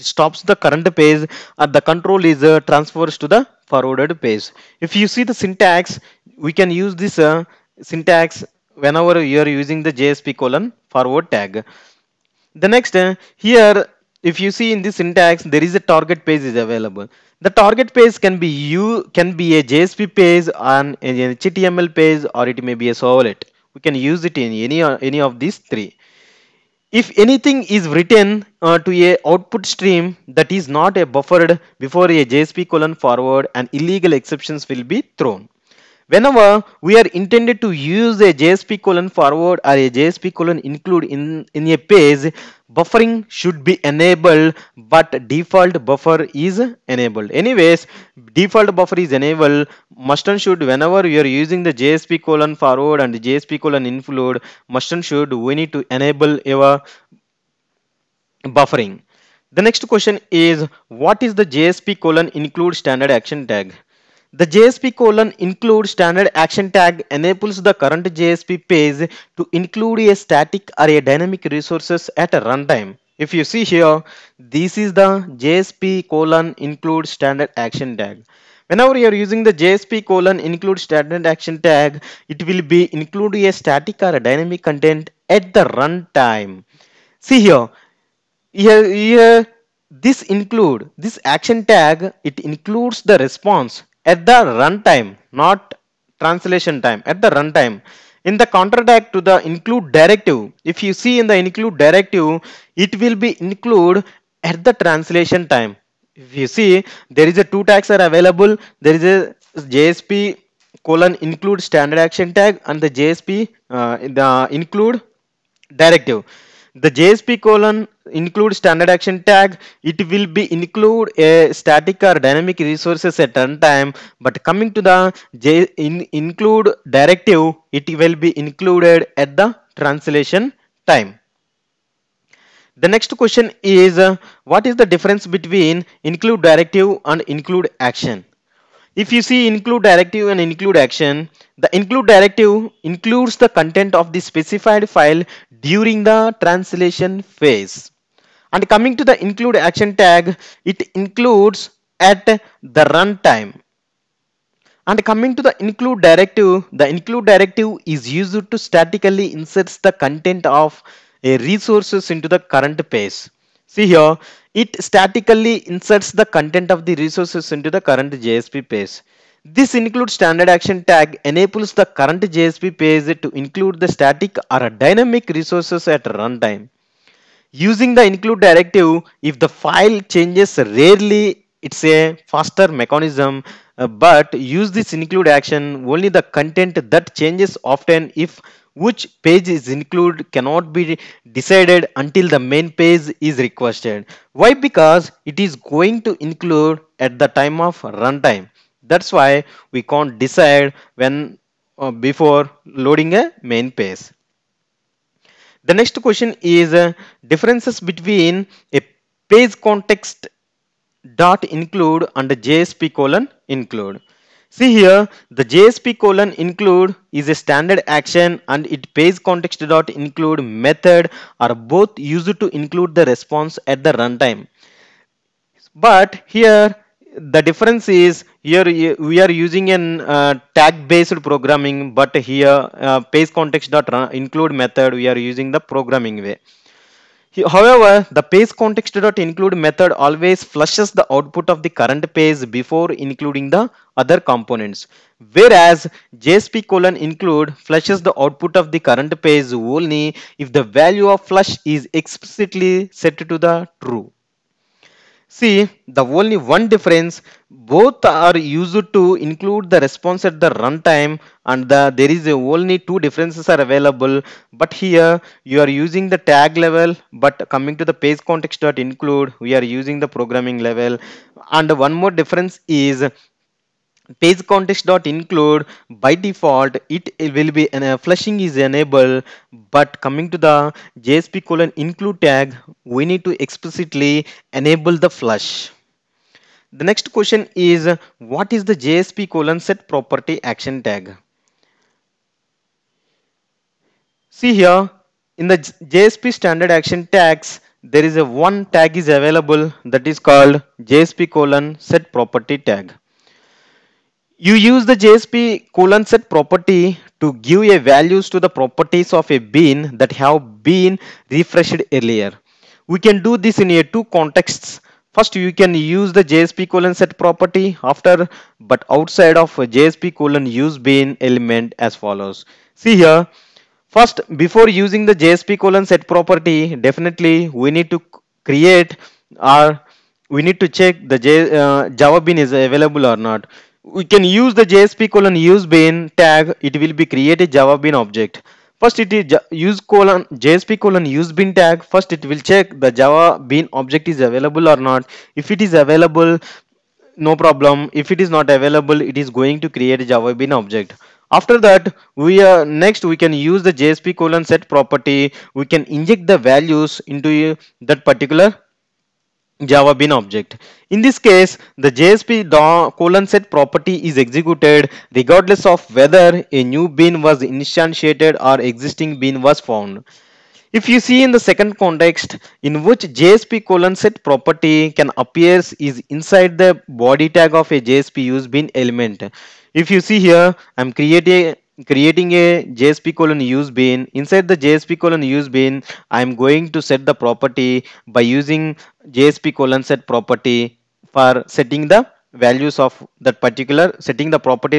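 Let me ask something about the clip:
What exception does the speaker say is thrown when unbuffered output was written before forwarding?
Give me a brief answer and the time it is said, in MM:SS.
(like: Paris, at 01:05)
illegal exceptions, at 00:33.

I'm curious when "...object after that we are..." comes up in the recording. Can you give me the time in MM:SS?
05:50.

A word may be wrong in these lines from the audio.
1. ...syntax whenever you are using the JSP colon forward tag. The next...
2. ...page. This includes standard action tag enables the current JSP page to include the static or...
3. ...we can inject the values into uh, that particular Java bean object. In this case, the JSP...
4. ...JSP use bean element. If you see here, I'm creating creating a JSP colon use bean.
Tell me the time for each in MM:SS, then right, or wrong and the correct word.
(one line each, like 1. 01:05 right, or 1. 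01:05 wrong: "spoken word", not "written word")
1. 00:07 right
2. 02:48 right
3. 05:55 right
4. 06:17 right.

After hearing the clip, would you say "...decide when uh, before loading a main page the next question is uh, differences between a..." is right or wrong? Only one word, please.
right.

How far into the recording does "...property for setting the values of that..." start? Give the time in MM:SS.
06:30.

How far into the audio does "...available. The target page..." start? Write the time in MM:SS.
00:16.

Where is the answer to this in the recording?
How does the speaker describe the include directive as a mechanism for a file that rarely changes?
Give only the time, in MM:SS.
03:02.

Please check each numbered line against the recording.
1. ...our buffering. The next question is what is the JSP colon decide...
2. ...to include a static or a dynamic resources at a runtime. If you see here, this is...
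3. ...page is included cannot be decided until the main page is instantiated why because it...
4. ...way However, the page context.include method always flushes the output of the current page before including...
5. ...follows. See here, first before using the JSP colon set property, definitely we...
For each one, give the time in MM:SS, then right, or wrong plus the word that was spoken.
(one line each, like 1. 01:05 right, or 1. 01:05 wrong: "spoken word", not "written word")
1. 00:56 wrong: "include", not "decide"
2. 01:09 right
3. 03:09 wrong: "requested", not "instantiated"
4. 03:56 right
5. 05:21 right.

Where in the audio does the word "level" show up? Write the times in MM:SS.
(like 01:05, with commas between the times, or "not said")
04:26, 04:30.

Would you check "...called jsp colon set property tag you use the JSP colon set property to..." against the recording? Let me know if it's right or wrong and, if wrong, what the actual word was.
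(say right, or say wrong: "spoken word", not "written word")
right.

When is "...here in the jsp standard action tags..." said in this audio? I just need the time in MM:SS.
04:54.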